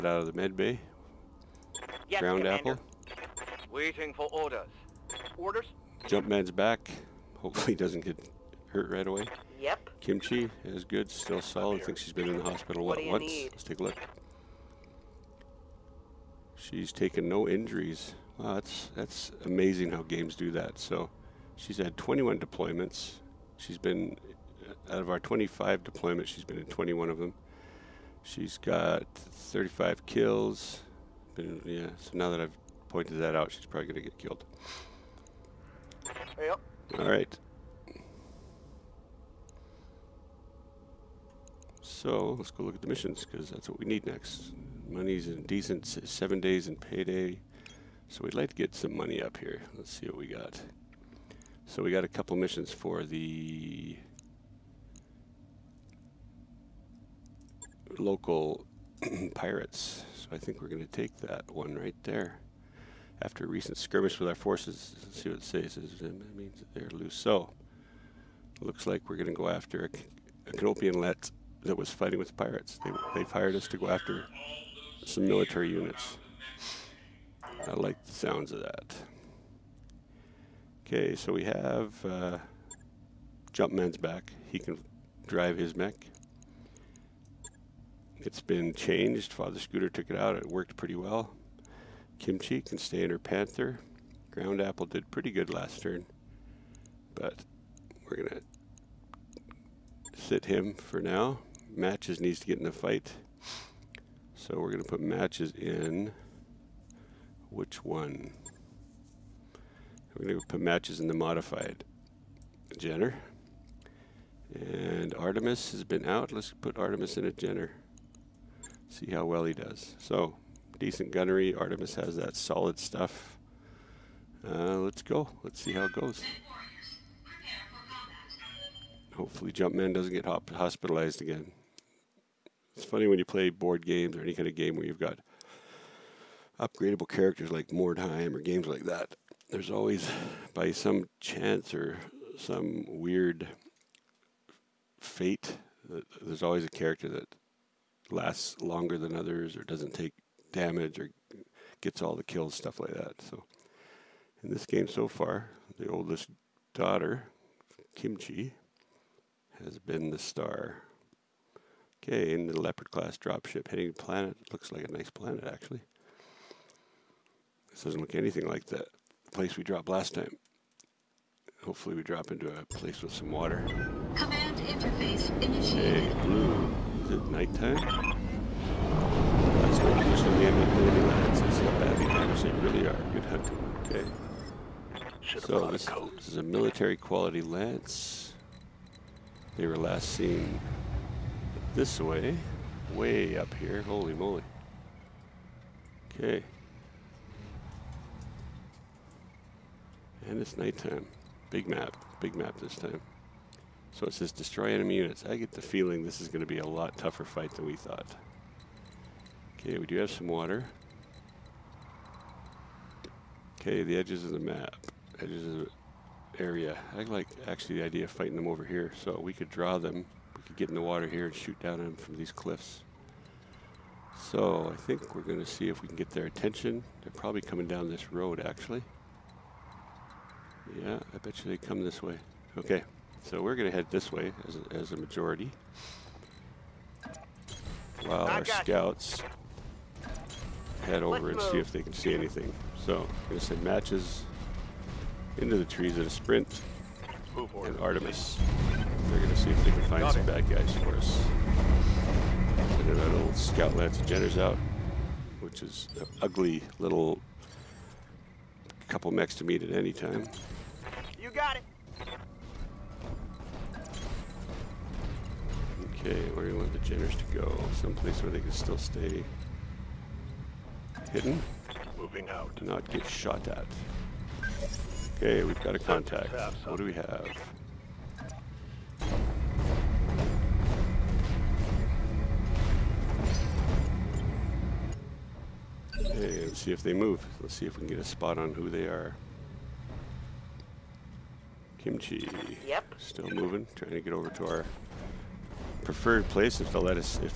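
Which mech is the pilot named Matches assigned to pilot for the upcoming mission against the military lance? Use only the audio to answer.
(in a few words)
Modified Jenner.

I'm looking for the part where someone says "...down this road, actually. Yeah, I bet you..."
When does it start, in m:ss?
3:47.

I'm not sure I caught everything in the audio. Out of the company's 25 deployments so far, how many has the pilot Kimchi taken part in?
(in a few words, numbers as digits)
21.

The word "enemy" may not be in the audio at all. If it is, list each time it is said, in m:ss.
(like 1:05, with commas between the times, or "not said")
3:00, 3:24.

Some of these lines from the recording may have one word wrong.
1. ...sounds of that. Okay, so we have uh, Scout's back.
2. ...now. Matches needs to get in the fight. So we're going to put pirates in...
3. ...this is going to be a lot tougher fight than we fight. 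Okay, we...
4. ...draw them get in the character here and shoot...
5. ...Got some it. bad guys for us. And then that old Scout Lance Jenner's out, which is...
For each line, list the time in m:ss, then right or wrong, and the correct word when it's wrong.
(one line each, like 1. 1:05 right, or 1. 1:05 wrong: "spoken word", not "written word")
1. 1:18 wrong: "Jumpman", not "Scout"
2. 1:41 wrong: "matches", not "pirates"
3. 3:26 wrong: "thought", not "fight"
4. 3:39 wrong: "water", not "character"
5. 4:10 right.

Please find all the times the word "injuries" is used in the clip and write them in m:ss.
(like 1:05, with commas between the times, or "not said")
0:17.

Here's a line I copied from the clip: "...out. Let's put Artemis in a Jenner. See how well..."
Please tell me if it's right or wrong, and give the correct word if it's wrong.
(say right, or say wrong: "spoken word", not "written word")
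right.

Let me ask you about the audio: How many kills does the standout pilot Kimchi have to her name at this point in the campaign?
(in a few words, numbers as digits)
35.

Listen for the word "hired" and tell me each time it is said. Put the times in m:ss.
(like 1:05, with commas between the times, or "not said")
1:13.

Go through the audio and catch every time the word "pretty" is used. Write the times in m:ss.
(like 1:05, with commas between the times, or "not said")
1:30, 1:35.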